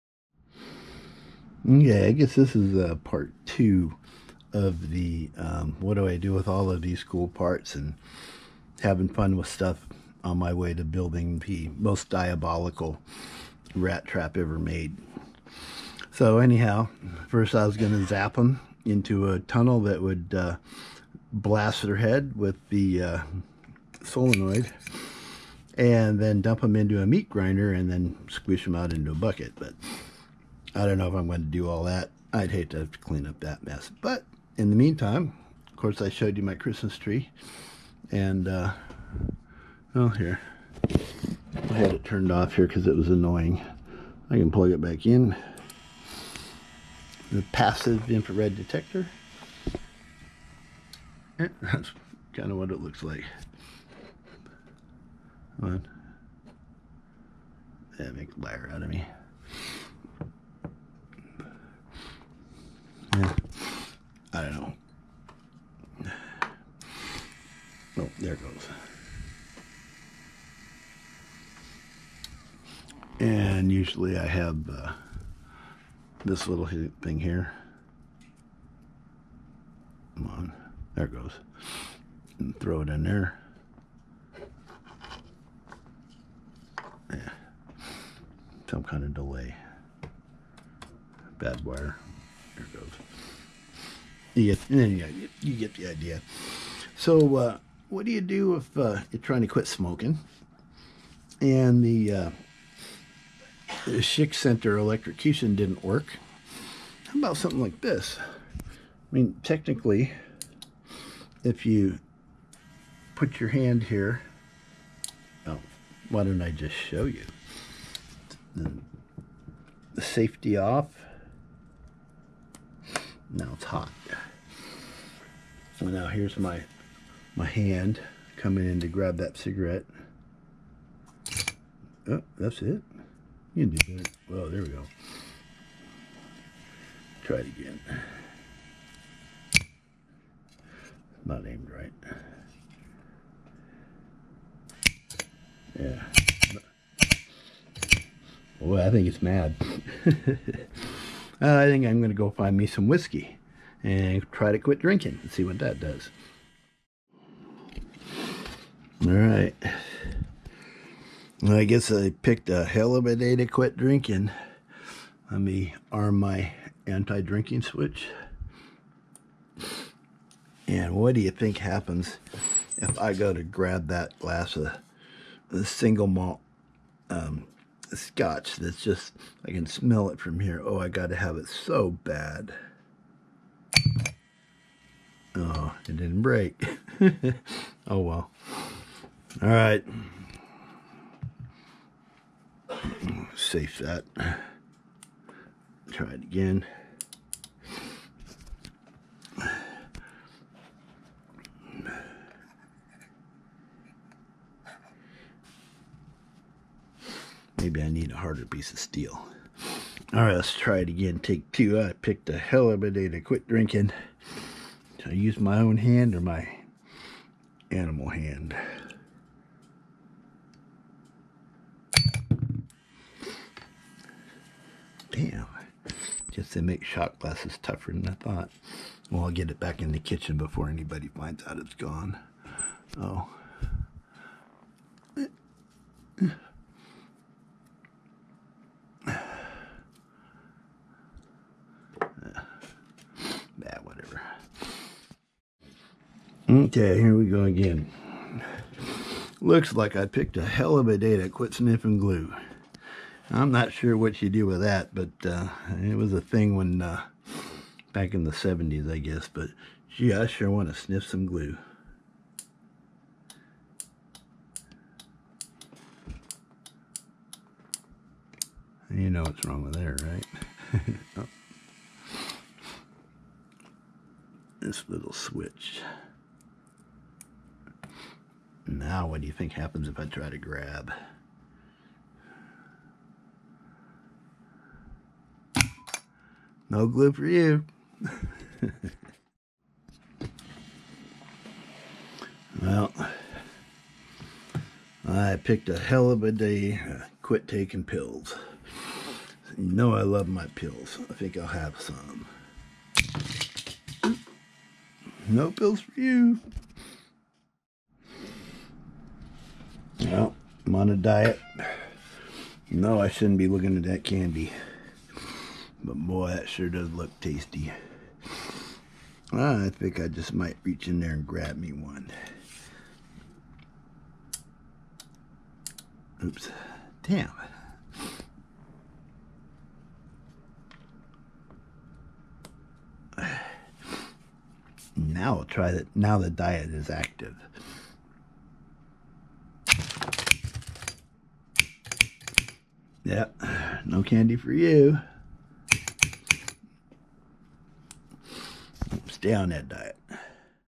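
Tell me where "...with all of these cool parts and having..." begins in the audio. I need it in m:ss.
0:06.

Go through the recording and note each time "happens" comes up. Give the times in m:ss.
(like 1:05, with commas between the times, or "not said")
2:51, 4:39.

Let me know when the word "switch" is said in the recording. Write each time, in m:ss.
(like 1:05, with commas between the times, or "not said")
2:47, 4:35.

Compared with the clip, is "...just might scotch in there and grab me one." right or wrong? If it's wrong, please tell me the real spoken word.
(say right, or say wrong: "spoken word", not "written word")
wrong: "reach", not "scotch".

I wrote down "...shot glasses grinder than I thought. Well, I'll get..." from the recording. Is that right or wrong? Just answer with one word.
wrong.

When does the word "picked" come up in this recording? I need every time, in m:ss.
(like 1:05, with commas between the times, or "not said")
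2:42, 3:32, 4:10, 4:55.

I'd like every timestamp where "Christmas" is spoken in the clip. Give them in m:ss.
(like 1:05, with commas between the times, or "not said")
0:36.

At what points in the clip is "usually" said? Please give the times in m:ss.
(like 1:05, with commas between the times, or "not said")
1:13.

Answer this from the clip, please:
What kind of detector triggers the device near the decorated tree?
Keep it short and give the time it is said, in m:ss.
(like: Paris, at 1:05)
passive infrared detector, at 0:47.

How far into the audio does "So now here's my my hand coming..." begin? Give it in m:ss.
2:05.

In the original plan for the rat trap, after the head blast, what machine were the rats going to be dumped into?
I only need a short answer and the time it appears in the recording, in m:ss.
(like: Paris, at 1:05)
meat grinder, at 0:27.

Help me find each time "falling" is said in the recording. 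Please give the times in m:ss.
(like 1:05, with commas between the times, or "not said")
not said.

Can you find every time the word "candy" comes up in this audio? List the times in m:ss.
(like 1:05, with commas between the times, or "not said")
5:14, 5:44.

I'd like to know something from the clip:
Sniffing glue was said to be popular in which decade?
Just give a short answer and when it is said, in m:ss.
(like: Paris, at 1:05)
the 70s, at 4:18.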